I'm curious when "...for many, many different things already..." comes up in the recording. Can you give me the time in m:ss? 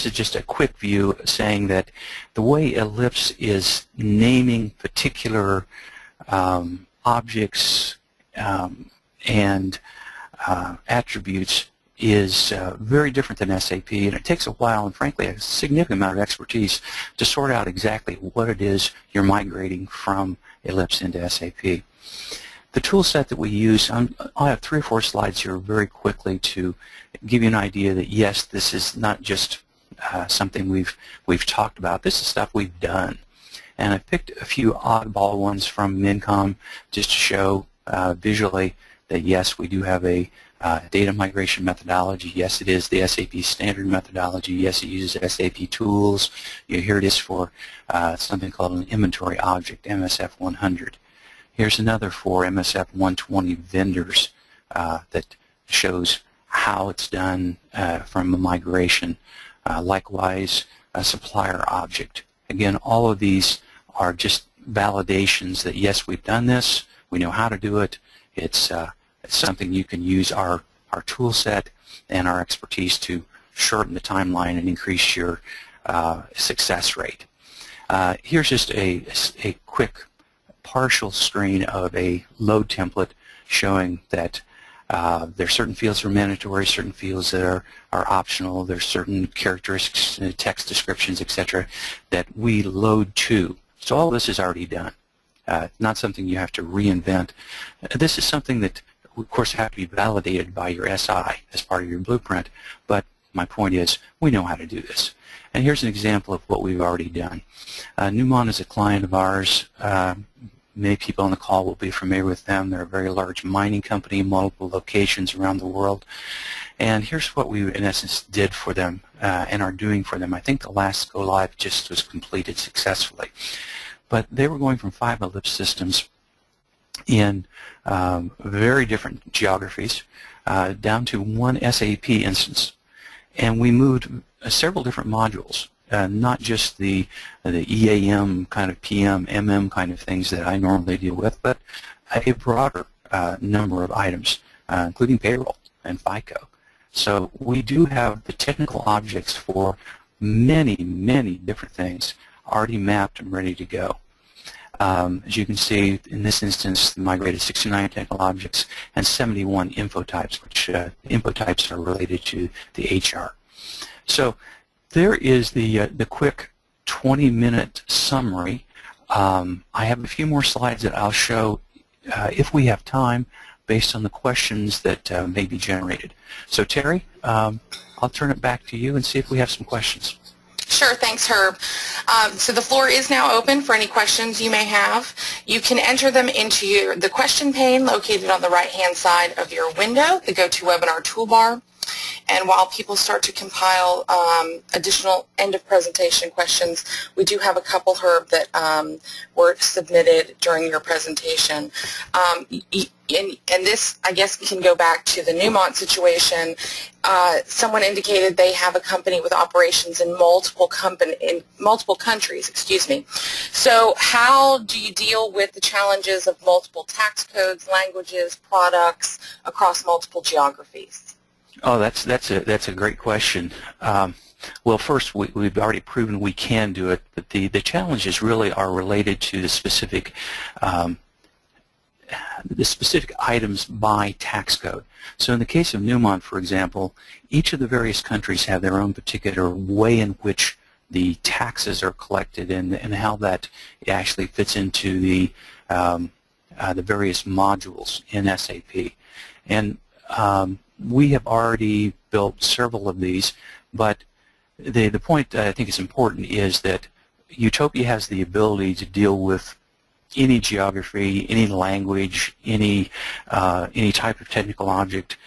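2:29.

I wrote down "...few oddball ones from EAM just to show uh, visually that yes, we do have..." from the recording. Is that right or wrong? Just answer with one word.
wrong.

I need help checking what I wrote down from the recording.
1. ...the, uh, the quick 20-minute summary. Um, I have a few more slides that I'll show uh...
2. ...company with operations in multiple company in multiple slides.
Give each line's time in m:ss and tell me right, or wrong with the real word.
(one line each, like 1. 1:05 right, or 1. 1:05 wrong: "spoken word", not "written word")
1. 2:45 right
2. 3:28 wrong: "countries", not "slides".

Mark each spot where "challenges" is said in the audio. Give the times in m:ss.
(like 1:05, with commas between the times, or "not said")
3:35, 3:47.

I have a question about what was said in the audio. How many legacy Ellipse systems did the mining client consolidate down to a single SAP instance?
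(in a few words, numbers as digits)
5.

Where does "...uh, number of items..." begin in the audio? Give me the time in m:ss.
2:23.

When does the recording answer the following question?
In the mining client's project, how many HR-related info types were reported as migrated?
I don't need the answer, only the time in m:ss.
2:39.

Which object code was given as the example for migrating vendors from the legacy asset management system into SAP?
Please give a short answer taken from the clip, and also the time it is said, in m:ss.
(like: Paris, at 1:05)
MSF 120, at 0:52.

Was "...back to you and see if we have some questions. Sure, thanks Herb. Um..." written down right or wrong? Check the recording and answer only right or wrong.
right.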